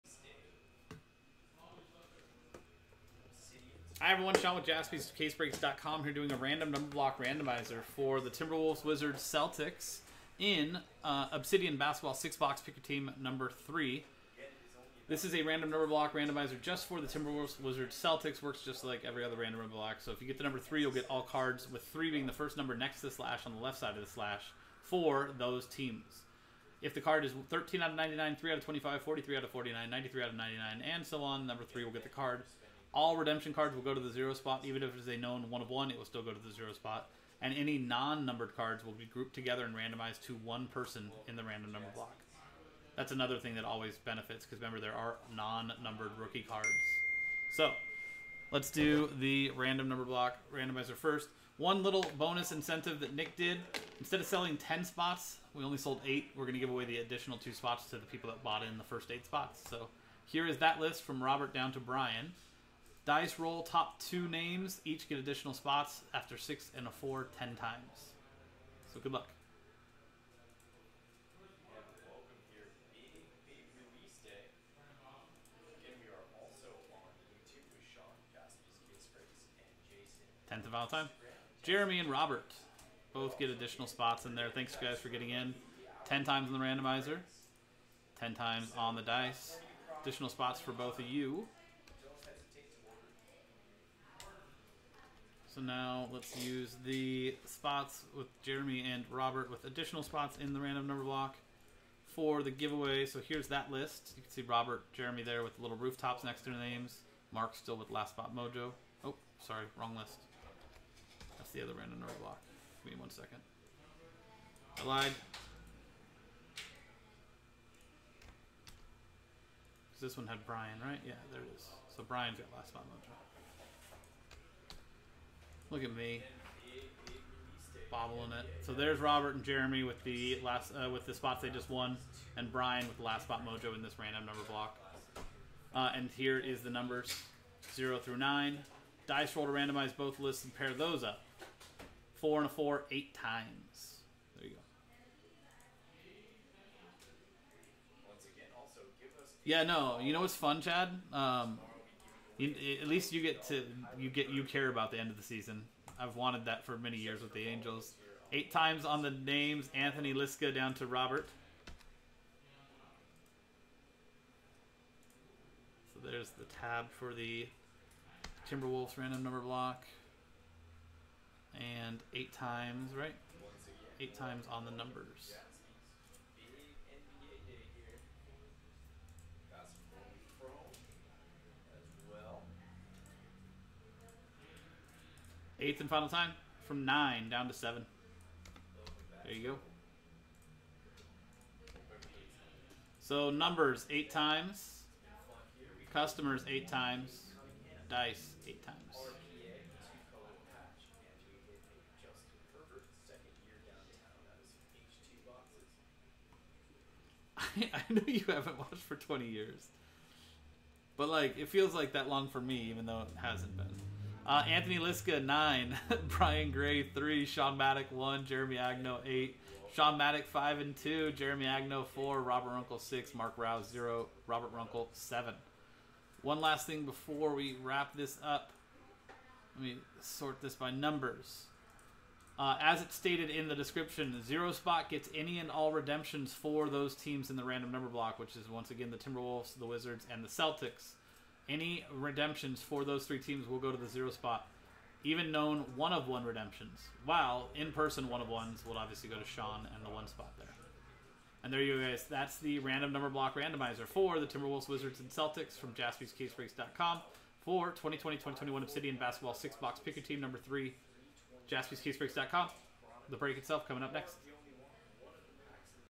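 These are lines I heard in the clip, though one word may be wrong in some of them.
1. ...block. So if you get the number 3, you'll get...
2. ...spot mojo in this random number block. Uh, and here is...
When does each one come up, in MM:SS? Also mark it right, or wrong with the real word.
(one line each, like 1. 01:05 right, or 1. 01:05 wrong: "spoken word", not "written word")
1. 00:19 right
2. 02:13 right.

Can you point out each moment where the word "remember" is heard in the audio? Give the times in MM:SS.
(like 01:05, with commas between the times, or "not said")
00:44.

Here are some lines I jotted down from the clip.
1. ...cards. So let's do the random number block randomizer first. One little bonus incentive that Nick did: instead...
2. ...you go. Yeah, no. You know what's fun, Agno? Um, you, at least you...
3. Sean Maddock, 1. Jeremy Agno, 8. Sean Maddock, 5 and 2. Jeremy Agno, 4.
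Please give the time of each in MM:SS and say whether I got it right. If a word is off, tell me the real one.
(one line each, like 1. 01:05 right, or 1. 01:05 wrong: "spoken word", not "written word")
1. 00:46 right
2. 02:24 wrong: "Chad", not "Agno"
3. 03:37 right.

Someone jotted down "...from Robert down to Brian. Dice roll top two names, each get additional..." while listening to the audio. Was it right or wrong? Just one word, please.
right.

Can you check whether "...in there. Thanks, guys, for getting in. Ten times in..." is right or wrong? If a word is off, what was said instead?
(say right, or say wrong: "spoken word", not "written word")
right.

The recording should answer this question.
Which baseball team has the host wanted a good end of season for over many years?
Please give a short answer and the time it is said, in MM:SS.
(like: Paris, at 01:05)
Angels, at 02:37.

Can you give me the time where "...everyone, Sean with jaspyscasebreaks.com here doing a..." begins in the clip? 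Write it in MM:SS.
00:04.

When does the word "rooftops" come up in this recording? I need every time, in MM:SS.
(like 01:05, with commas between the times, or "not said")
01:45.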